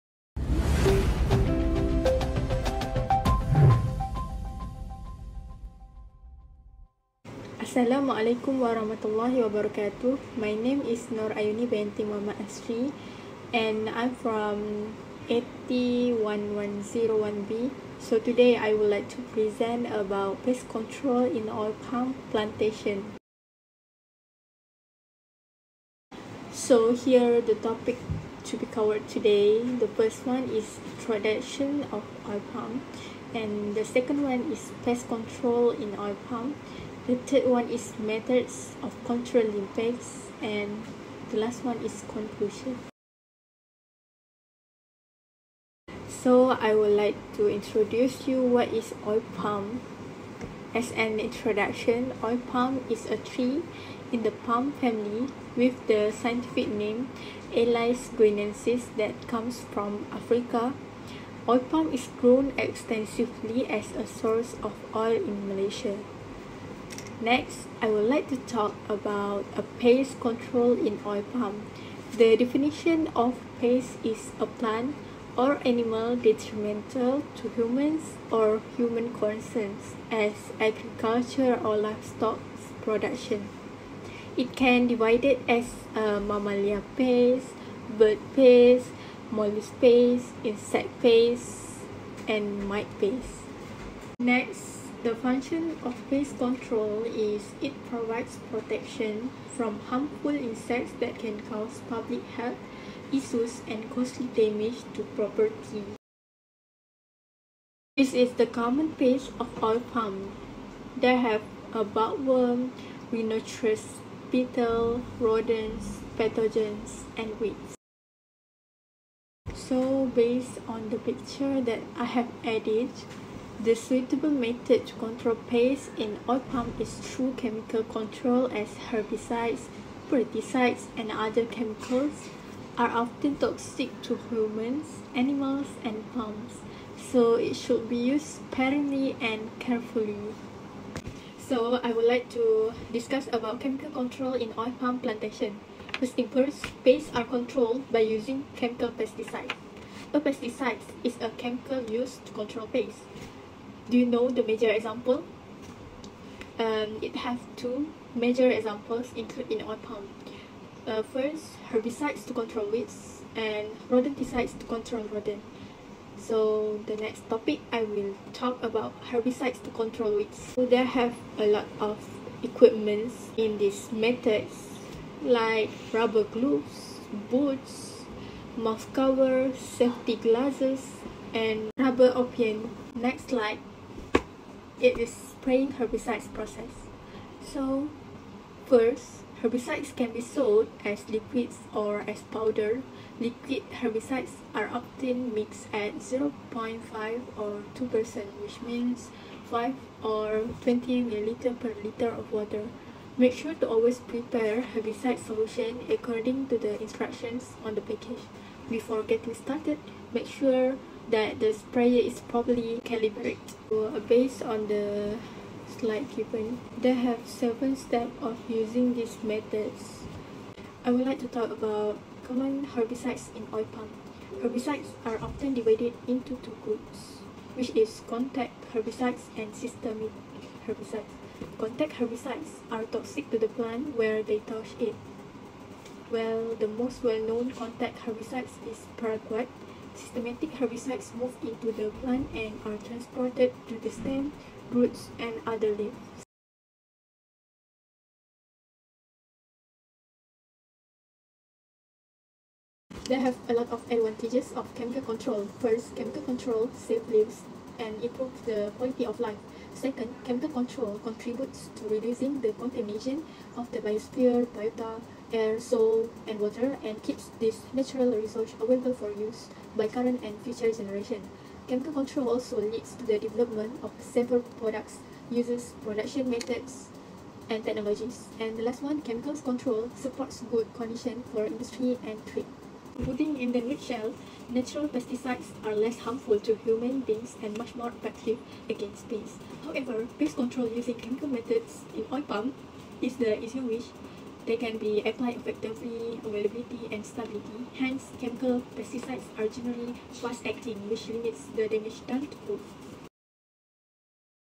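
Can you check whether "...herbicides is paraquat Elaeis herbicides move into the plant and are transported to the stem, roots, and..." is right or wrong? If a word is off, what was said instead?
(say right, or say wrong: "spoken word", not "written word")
wrong: "Systematic", not "Elaeis".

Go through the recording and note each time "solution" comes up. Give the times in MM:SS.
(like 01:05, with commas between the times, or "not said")
03:25.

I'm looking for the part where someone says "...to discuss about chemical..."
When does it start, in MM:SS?
02:22.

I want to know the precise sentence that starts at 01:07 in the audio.
Next, I would like to talk about a pest control in oil palm.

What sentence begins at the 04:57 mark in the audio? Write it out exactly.
Hence, chemical pesticides are generally fast-acting, which limits the damage done to food.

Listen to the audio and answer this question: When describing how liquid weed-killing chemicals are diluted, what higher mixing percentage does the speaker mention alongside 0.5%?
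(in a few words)
2%.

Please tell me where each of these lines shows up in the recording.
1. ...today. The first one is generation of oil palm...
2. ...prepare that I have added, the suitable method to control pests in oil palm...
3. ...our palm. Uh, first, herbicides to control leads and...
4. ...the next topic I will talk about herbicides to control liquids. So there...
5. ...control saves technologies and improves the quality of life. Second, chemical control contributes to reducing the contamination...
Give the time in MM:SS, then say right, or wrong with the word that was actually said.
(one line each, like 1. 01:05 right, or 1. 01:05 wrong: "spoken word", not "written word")
1. 00:29 wrong: "production", not "generation"
2. 02:00 wrong: "picture", not "prepare"
3. 02:39 wrong: "weeds", not "leads"
4. 02:46 wrong: "weeds", not "liquids"
5. 04:16 wrong: "lives", not "technologies".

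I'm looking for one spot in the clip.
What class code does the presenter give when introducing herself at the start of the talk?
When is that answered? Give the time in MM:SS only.
00:15.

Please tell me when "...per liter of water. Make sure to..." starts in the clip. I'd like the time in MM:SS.
03:21.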